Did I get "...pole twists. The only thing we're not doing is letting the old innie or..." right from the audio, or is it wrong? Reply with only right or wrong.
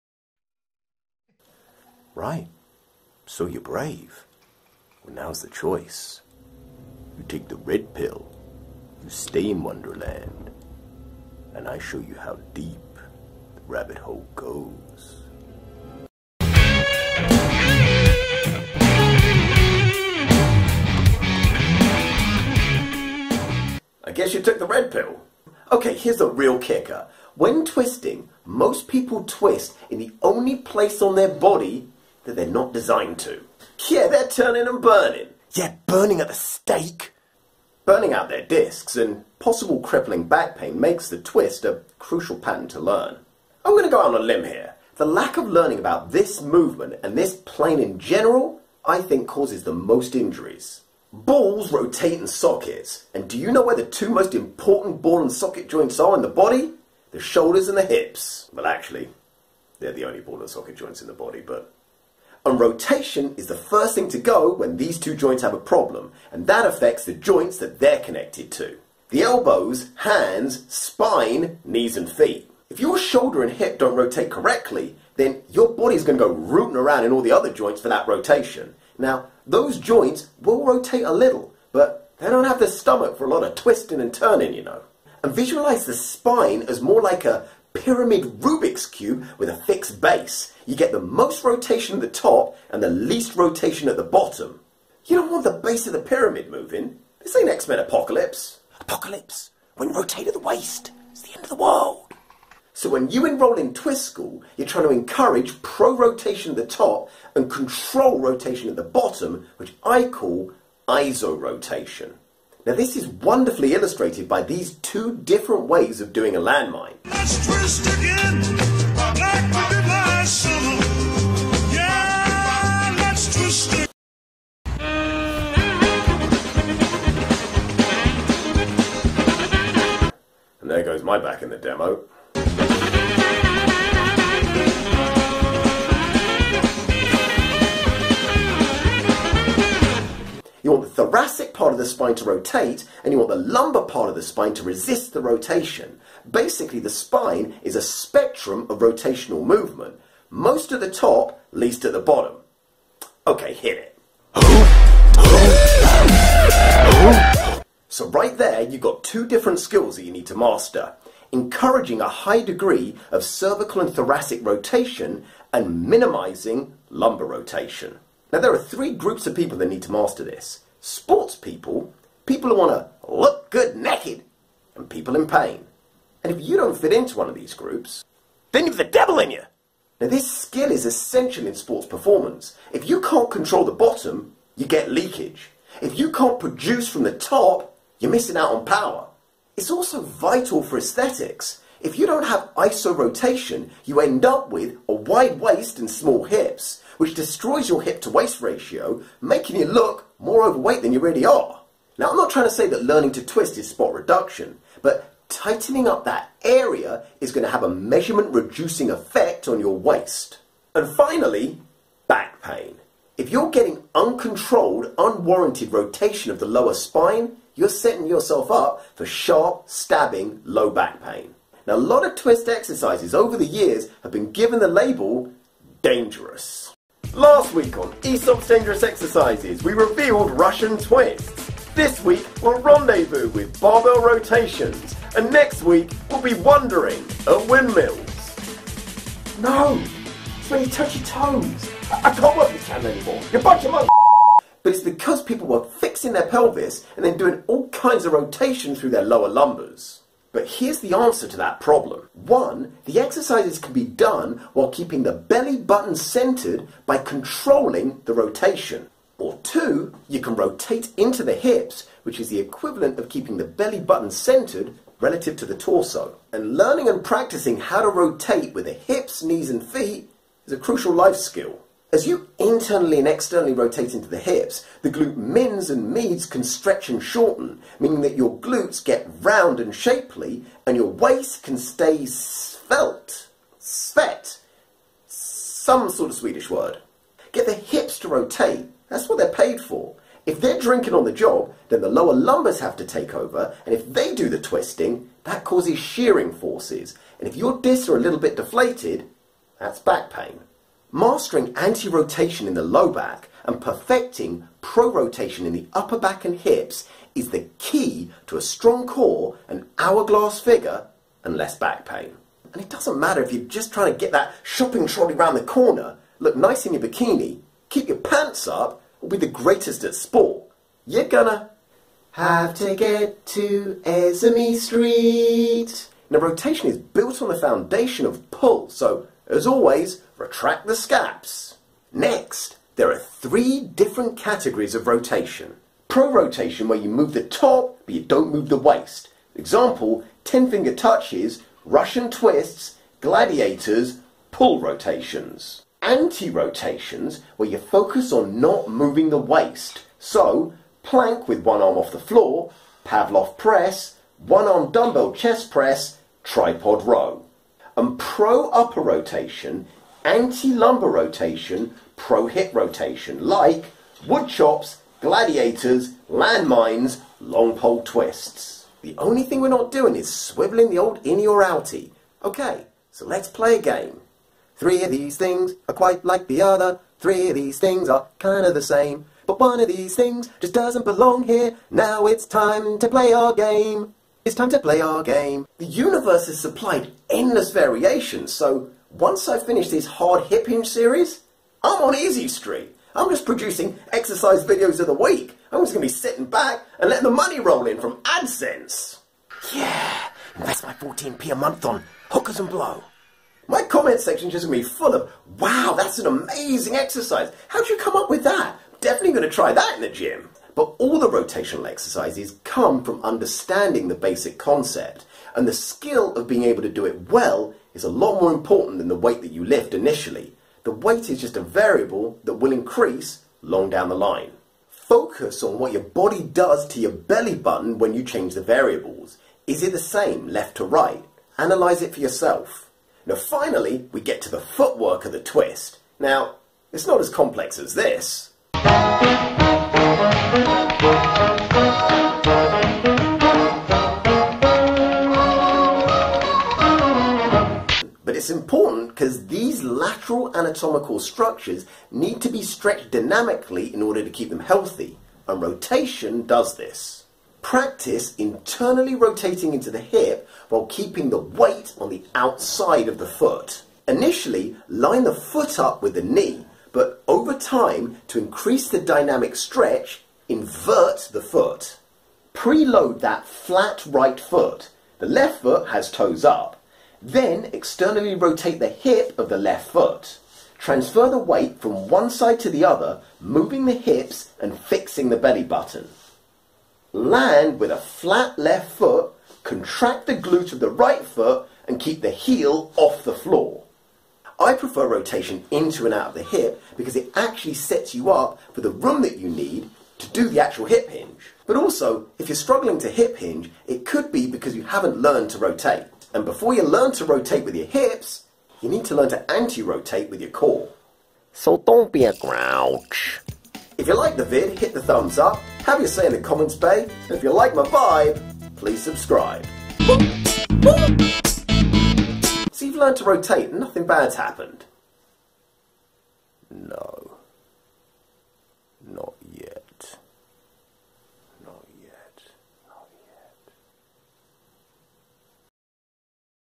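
wrong.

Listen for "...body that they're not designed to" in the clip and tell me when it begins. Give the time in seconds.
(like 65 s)
31 s.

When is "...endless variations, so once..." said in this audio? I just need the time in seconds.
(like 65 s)
387 s.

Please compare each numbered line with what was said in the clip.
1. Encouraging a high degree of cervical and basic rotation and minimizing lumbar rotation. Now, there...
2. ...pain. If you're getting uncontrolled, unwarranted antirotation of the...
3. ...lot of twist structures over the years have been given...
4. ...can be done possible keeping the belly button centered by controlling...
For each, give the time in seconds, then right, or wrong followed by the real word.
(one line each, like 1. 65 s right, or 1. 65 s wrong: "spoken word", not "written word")
1. 161 s wrong: "thoracic", not "basic"
2. 212 s wrong: "rotation", not "antirotation"
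3. 221 s wrong: "exercises", not "structures"
4. 253 s wrong: "while", not "possible".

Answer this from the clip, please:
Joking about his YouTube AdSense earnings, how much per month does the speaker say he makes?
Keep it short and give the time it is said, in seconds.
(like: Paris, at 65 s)
14p, at 400 s.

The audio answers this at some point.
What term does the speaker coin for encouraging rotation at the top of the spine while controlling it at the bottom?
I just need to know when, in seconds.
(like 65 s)
110 s.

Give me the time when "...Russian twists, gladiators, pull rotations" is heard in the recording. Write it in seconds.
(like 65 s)
341 s.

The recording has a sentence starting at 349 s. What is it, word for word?
So, plank with one arm off the floor, Pallof press, one arm dumbbell chest press, tripod row.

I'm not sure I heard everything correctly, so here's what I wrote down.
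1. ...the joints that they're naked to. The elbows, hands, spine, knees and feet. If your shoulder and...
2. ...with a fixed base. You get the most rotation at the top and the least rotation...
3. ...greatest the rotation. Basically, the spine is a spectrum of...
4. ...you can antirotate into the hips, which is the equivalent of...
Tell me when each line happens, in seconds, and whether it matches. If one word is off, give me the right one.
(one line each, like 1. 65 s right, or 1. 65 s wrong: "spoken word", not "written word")
1. 67 s wrong: "connected", not "naked"
2. 89 s right
3. 144 s wrong: "resist", not "greatest"
4. 260 s wrong: "rotate", not "antirotate".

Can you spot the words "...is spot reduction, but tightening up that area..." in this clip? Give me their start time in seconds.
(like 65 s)
203 s.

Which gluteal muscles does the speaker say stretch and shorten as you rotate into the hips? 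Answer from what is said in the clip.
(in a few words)
glute mins and meads.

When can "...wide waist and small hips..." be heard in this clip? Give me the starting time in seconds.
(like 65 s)
194 s.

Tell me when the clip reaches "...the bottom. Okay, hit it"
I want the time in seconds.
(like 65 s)
151 s.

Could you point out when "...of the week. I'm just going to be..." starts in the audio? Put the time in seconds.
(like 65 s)
394 s.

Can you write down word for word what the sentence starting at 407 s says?
How'd you come up with that?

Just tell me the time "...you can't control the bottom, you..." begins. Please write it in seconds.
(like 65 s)
182 s.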